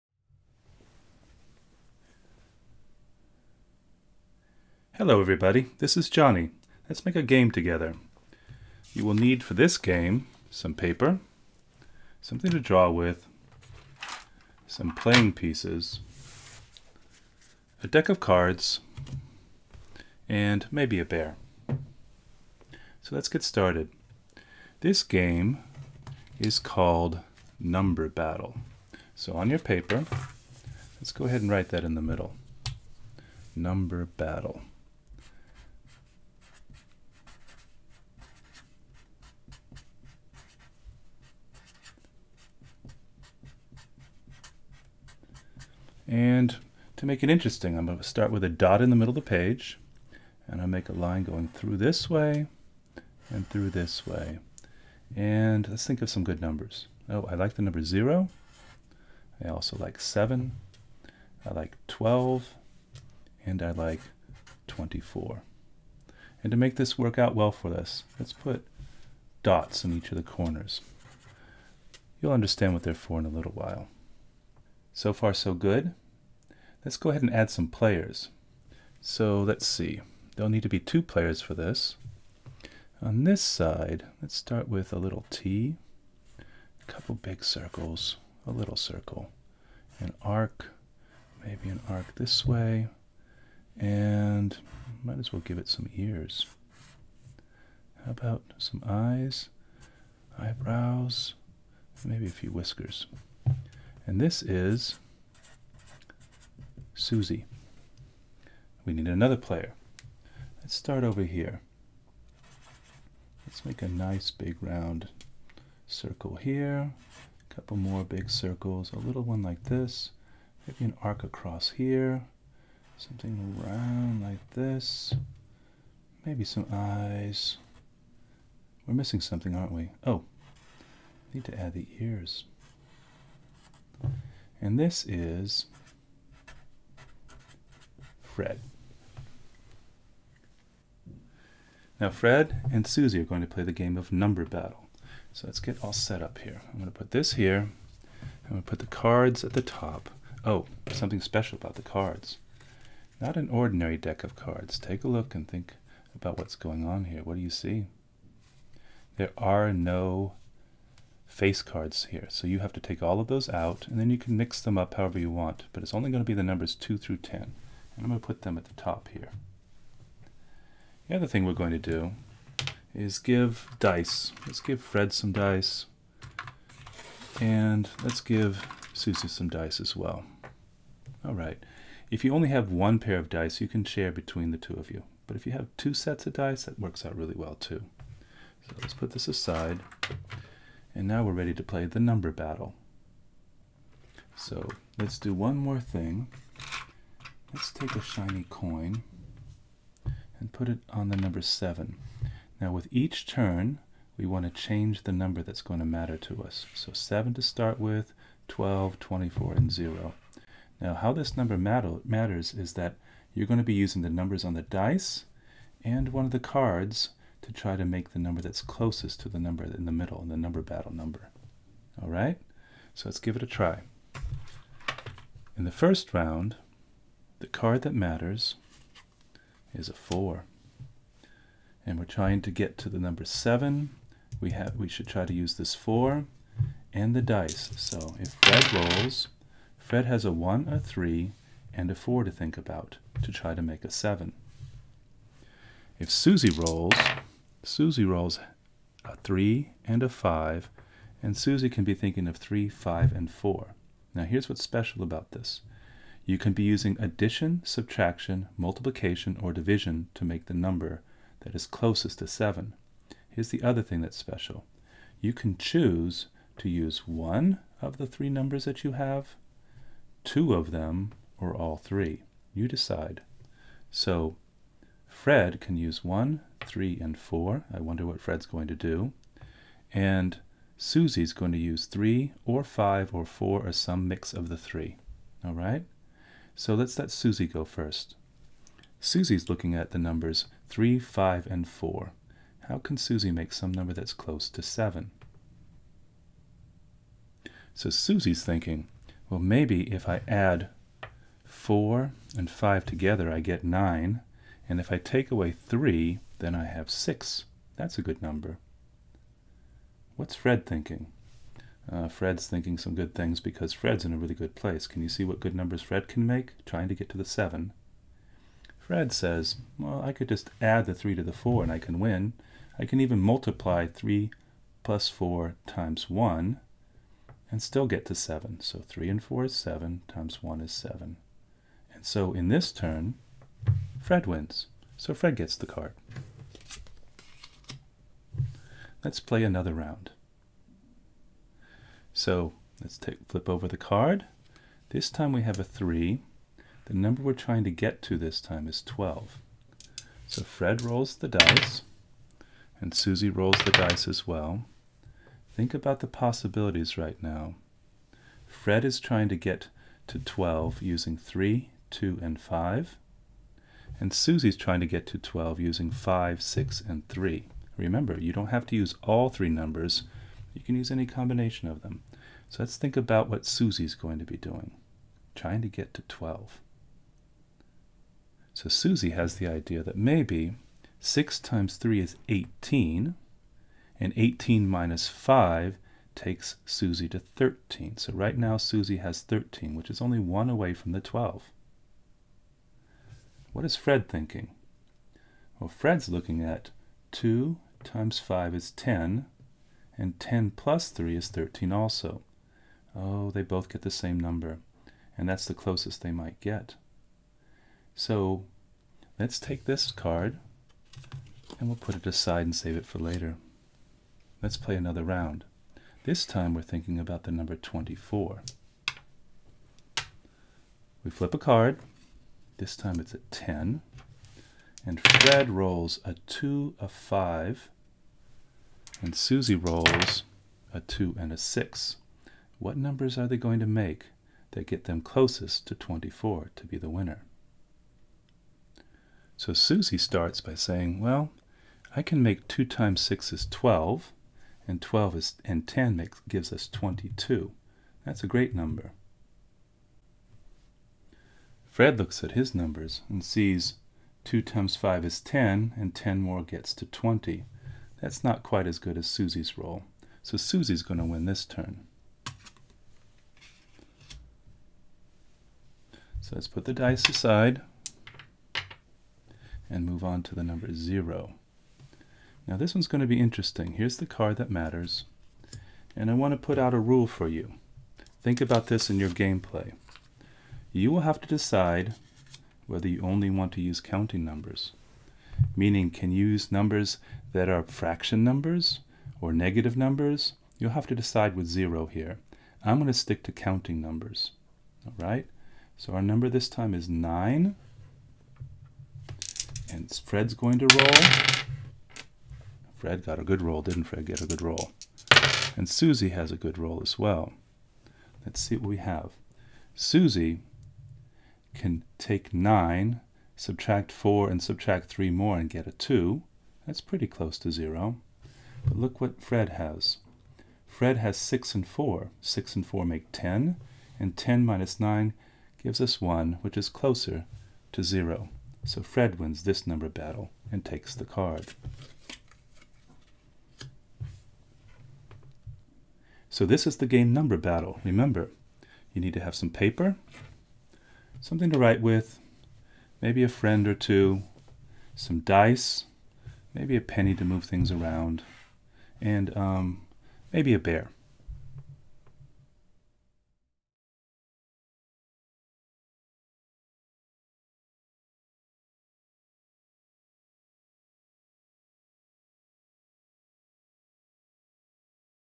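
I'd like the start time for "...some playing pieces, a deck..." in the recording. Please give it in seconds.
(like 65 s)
14 s.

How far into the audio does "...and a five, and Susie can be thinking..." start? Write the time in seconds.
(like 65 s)
249 s.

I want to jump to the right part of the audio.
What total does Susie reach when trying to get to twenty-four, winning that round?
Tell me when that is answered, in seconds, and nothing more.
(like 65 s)
446 s.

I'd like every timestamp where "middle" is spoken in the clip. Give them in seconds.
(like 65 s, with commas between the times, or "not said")
32 s, 48 s, 219 s.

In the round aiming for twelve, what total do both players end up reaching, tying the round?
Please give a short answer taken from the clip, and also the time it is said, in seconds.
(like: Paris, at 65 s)
13, at 401 s.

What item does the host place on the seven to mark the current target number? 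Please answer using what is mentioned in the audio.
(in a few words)
shiny coin.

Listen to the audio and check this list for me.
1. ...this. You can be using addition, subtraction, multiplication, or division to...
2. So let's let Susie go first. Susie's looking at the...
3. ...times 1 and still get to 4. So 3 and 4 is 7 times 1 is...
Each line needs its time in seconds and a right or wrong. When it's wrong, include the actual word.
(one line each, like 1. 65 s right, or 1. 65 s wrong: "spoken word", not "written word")
1. 255 s right
2. 286 s right
3. 325 s wrong: "7", not "4".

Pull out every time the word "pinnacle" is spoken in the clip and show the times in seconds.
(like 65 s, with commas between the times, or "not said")
not said.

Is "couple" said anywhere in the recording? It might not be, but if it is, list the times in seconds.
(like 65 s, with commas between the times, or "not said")
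86 s, 117 s.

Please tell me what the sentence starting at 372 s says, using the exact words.
So let's think about what Susie's going to be doing, trying to get to 12.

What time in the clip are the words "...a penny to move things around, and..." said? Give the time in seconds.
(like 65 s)
546 s.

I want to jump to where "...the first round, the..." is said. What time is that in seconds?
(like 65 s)
225 s.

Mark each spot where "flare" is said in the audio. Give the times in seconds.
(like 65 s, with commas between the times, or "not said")
not said.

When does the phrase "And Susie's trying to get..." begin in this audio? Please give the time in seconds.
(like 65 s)
363 s.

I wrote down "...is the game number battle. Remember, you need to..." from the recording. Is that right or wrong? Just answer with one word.
right.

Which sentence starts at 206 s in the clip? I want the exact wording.
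So 7 to start with, 12, 24, and 0.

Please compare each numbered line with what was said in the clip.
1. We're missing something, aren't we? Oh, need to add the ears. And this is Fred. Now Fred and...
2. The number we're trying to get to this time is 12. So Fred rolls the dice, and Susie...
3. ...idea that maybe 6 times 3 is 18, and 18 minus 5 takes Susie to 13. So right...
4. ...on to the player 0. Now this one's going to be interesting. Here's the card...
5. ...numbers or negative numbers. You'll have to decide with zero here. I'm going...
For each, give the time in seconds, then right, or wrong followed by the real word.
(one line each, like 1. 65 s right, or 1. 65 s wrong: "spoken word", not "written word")
1. 128 s right
2. 346 s right
3. 379 s right
4. 470 s wrong: "number", not "player"
5. 488 s right.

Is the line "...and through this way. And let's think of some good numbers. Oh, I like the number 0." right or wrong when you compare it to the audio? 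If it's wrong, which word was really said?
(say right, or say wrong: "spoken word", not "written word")
right.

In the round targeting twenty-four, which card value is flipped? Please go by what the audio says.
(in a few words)
10.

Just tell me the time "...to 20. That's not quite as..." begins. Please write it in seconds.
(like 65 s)
456 s.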